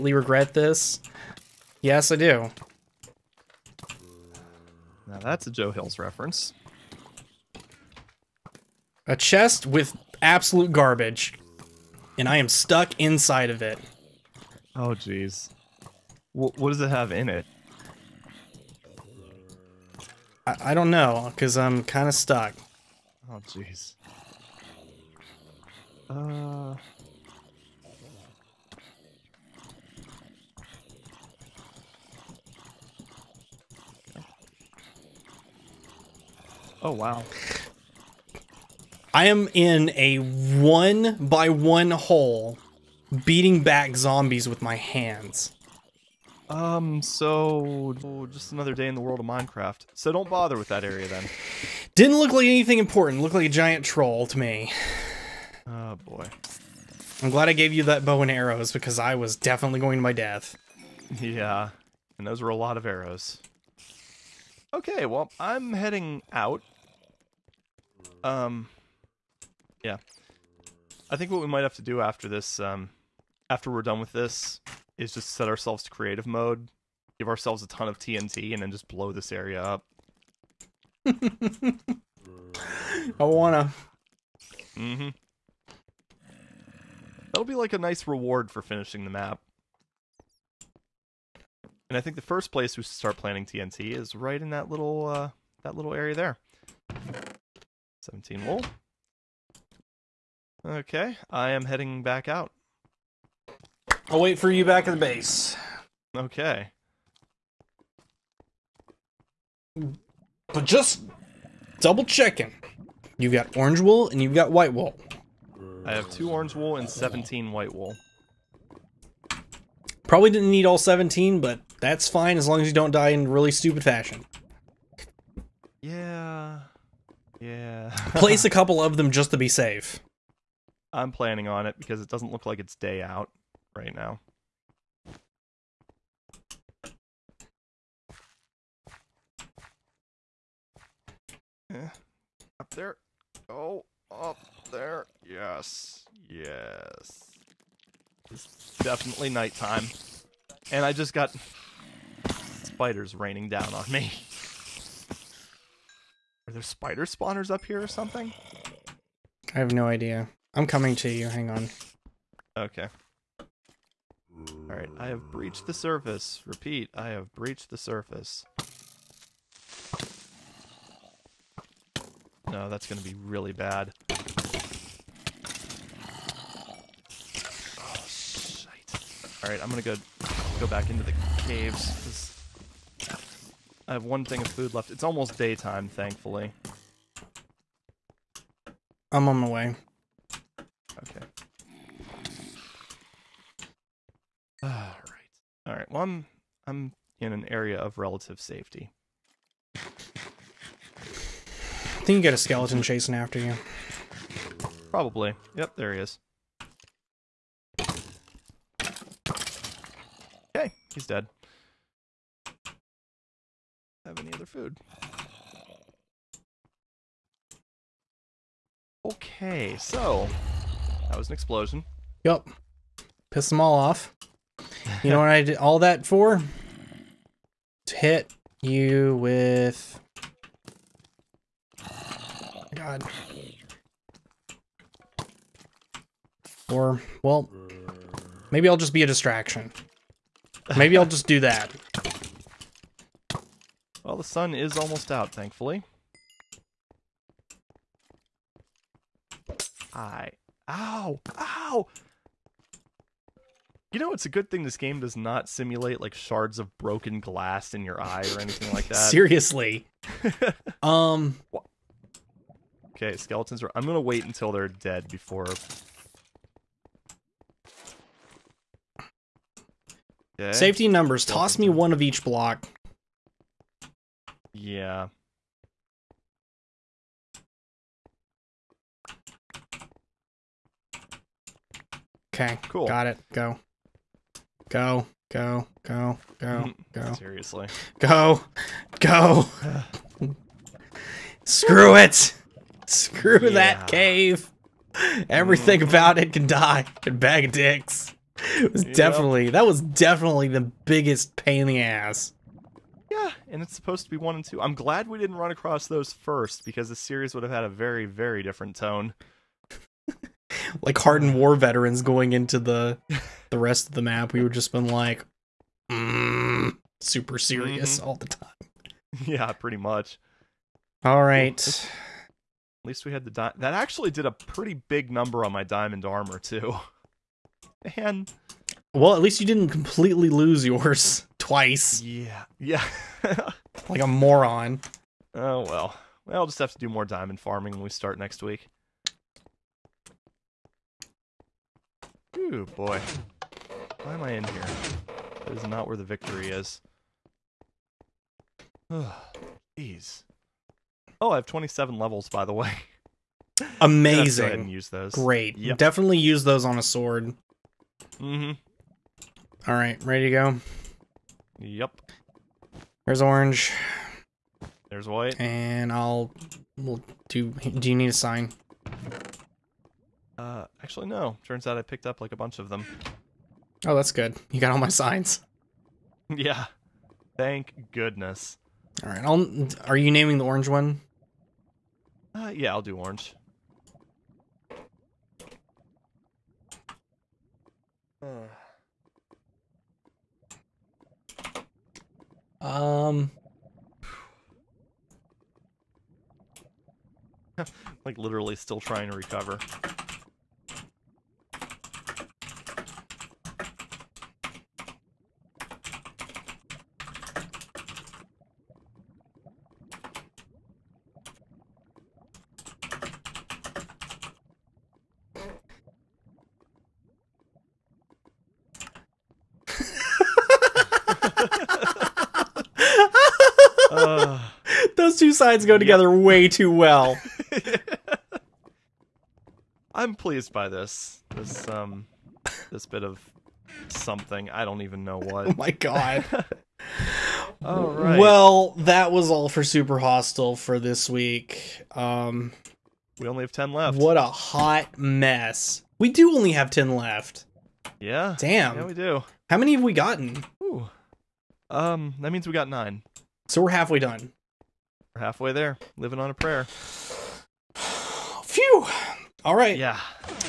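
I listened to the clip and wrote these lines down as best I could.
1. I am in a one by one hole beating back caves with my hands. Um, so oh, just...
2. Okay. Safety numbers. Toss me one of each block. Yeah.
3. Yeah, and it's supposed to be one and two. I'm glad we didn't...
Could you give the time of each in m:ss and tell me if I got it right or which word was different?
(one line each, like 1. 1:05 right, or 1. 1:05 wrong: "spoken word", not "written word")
1. 0:39 wrong: "zombies", not "caves"
2. 4:30 right
3. 5:03 right.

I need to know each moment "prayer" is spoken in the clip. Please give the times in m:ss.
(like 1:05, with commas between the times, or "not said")
7:36.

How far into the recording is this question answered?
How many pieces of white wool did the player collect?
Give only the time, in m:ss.
1:56.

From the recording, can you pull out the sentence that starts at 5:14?
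We would just been like mm, super serious mm -hmm.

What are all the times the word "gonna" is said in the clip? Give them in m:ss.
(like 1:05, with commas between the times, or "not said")
2:52, 2:59, 4:23.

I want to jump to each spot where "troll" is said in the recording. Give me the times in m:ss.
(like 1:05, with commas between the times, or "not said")
0:53.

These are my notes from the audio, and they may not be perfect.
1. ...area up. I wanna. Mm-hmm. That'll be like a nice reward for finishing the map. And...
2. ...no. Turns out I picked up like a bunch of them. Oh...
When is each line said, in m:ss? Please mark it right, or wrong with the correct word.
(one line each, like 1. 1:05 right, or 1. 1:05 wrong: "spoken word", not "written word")
1. 1:19 right
2. 6:11 right.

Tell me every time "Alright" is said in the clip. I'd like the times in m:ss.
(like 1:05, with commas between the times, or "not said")
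2:44, 2:59.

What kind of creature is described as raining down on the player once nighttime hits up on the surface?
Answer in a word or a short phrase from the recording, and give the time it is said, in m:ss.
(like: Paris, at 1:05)
Spiders, at 2:32.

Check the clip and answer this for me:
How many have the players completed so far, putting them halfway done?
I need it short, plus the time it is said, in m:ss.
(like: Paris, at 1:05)
9, at 7:32.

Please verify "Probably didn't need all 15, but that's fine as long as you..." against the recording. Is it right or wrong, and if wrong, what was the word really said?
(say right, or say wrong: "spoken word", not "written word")
wrong: "17", not "15".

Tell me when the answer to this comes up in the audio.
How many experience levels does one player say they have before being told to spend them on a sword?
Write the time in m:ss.
5:51.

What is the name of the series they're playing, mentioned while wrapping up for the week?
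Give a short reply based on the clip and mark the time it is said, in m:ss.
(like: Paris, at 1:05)
Super Hostile, at 7:19.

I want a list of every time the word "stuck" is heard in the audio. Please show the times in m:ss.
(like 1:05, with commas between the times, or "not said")
0:12, 0:22.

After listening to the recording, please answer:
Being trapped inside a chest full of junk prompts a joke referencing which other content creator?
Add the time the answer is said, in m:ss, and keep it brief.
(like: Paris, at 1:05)
Joe Hills, at 0:05.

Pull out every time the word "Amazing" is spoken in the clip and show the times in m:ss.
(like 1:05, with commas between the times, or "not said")
5:53.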